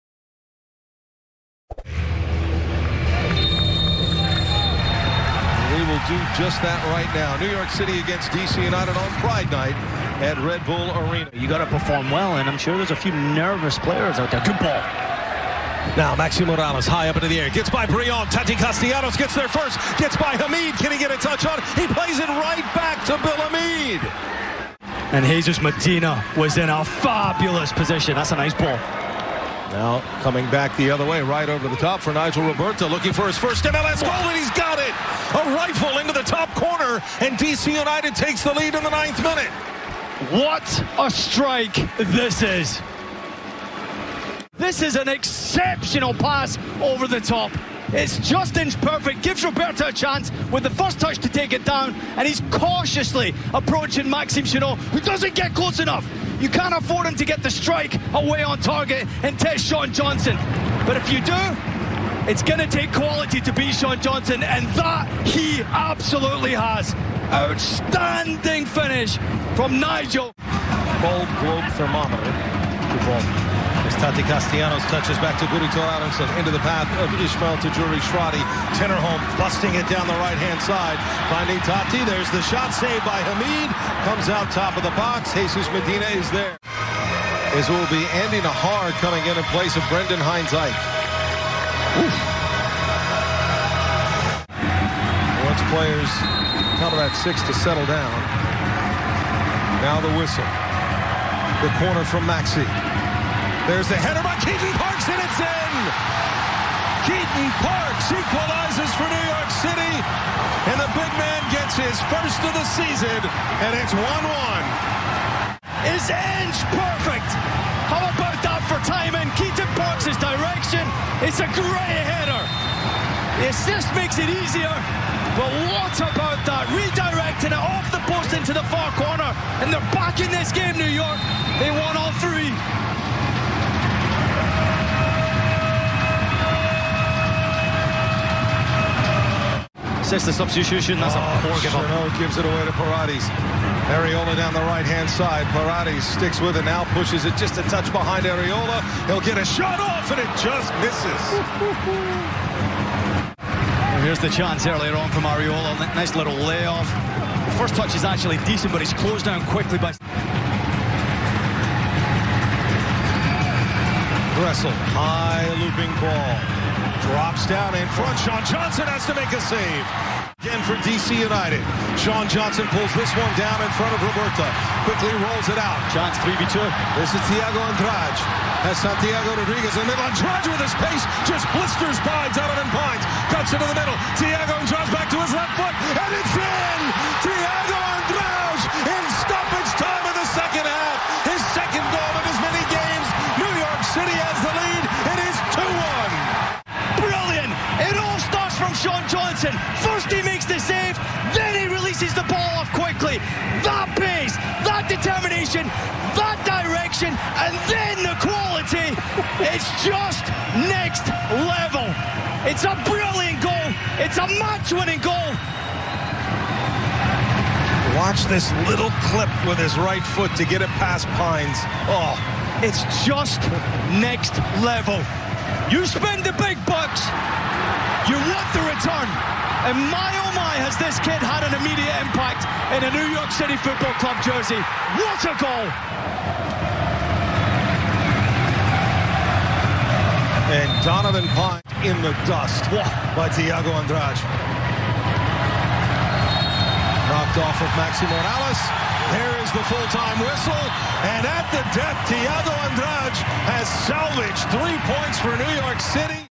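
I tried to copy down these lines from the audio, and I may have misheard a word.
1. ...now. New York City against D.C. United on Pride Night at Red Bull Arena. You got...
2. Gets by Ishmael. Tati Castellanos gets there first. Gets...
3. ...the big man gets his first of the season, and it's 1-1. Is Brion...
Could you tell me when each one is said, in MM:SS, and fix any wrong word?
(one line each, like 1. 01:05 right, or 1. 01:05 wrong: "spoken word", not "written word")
1. 00:07 right
2. 00:17 wrong: "Brion", not "Ishmael"
3. 01:50 wrong: "Ange", not "Brion".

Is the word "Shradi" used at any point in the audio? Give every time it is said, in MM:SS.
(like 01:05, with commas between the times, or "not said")
01:18.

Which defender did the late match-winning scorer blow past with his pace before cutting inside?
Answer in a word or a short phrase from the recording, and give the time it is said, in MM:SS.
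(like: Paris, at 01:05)
Donovan Pines, at 03:02.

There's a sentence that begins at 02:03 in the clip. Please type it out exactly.
The assist makes it easier, but what about that?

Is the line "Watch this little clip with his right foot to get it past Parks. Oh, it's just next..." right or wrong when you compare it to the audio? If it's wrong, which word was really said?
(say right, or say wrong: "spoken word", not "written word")
wrong: "Pines", not "Parks".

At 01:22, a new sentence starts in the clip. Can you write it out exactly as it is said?
There's the shot saved by Hamid.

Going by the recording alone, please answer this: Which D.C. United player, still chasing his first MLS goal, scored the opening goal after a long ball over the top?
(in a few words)
Nigel Robertha.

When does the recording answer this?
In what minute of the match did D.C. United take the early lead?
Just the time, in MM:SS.
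00:38.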